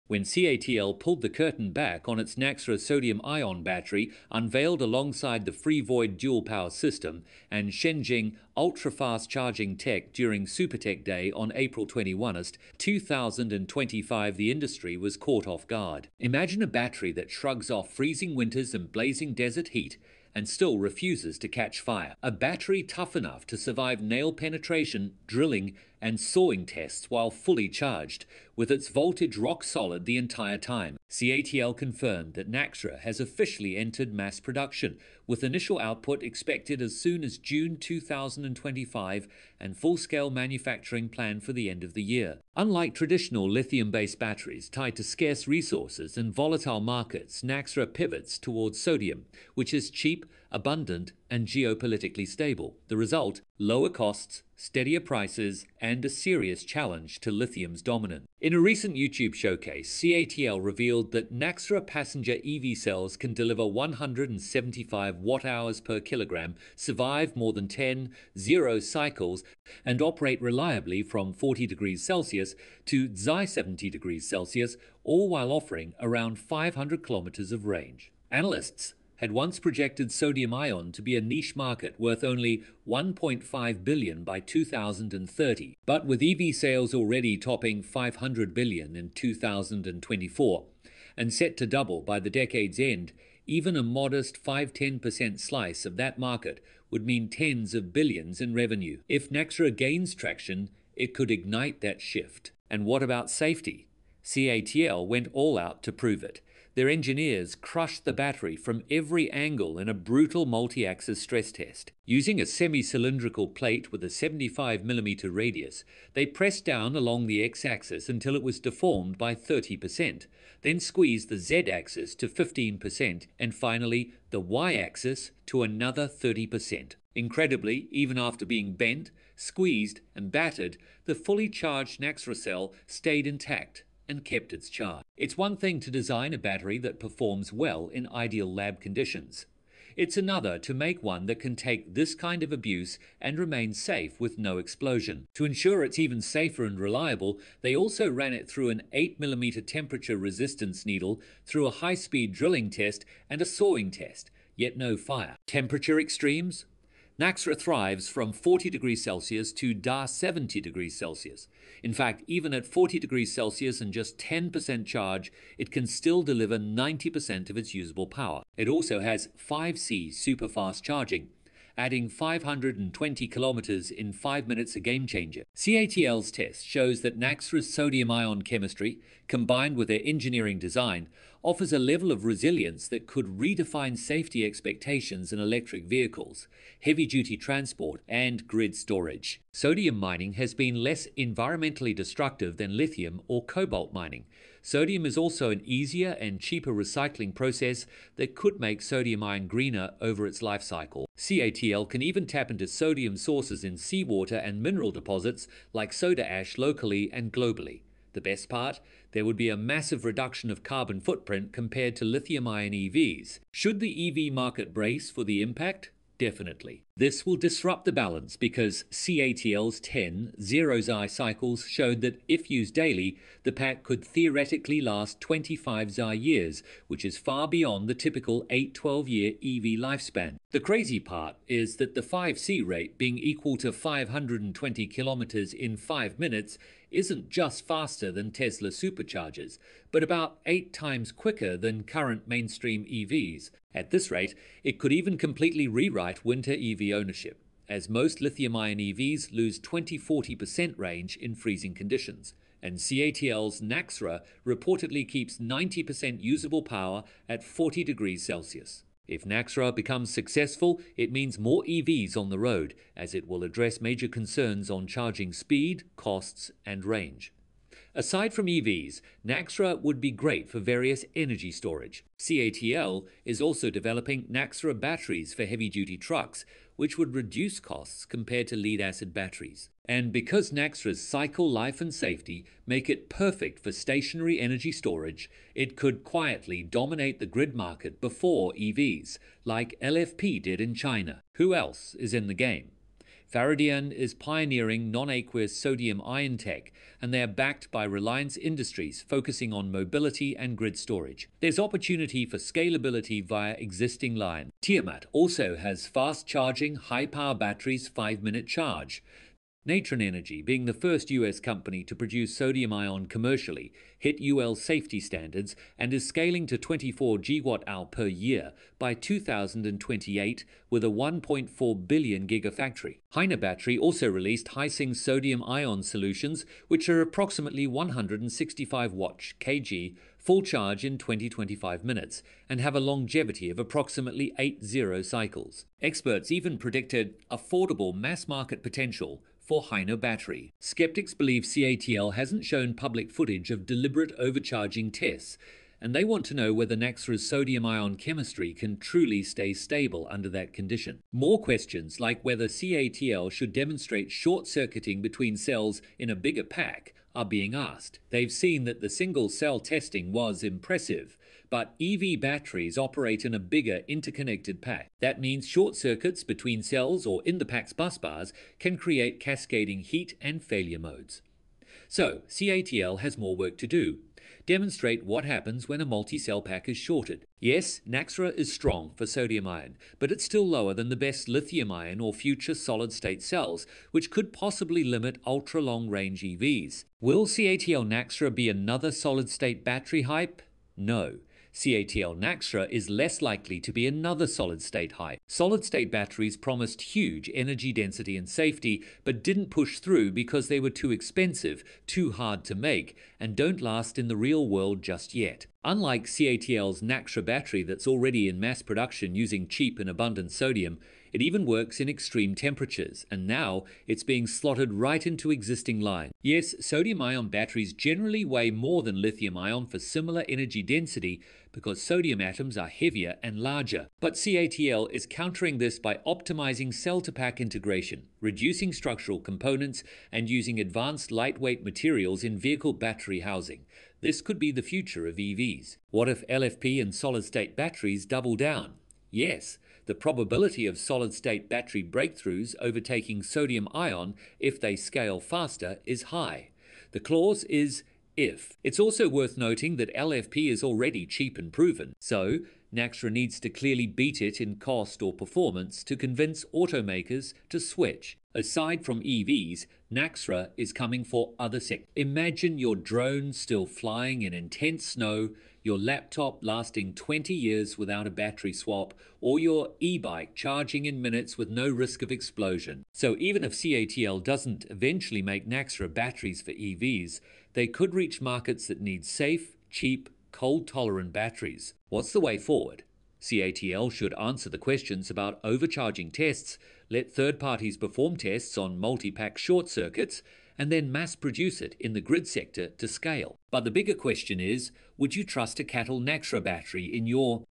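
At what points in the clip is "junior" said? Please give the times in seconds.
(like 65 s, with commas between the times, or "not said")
not said.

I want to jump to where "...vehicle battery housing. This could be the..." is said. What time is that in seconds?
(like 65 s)
432 s.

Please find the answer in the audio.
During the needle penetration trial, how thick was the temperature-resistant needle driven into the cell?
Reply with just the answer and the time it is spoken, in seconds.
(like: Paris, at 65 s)
8mm, at 148 s.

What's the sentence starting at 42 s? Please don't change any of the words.
Unlike traditional lithium-based batteries tied to scarce resources and volatile markets, Naxtra pivots towards sodium, which is cheap, abundant, and geopolitically stable.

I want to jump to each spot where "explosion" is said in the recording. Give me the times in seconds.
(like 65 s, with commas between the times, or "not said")
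144 s, 472 s.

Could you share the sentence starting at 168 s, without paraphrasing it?
It also has 5C super fast charging, adding 520 kilometers in 5 minutes a game changer.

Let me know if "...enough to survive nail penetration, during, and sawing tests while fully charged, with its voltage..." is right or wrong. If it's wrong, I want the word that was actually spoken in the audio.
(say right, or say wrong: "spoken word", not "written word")
wrong: "drilling", not "during".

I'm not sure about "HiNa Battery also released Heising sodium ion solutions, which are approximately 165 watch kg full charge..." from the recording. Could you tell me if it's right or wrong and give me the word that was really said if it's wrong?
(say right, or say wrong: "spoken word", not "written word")
right.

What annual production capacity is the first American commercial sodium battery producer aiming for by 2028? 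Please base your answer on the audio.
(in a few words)
24 gigawatt-hour per year.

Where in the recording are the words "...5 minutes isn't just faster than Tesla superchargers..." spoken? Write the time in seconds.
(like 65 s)
235 s.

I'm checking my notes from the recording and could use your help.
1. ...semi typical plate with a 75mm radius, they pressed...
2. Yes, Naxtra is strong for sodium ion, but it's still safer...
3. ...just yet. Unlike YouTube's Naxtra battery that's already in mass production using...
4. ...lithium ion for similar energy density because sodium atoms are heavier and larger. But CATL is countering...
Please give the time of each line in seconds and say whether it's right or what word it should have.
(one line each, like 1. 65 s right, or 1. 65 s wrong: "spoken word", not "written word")
1. 112 s wrong: "cylindrical", not "typical"
2. 377 s wrong: "lower", not "safer"
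3. 404 s wrong: "CATL", not "YouTube"
4. 419 s right.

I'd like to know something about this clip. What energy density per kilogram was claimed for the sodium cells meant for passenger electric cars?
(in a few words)
175 watt hours per kilogram.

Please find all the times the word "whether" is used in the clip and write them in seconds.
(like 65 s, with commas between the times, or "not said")
346 s, 352 s.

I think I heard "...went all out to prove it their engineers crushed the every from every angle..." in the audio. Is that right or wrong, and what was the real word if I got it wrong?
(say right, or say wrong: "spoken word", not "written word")
wrong: "battery", not "every".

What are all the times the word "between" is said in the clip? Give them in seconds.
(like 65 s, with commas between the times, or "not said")
355 s, 366 s.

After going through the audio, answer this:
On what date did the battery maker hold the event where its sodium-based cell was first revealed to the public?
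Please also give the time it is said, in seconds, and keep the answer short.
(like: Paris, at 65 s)
April 21st, 2025, at 11 s.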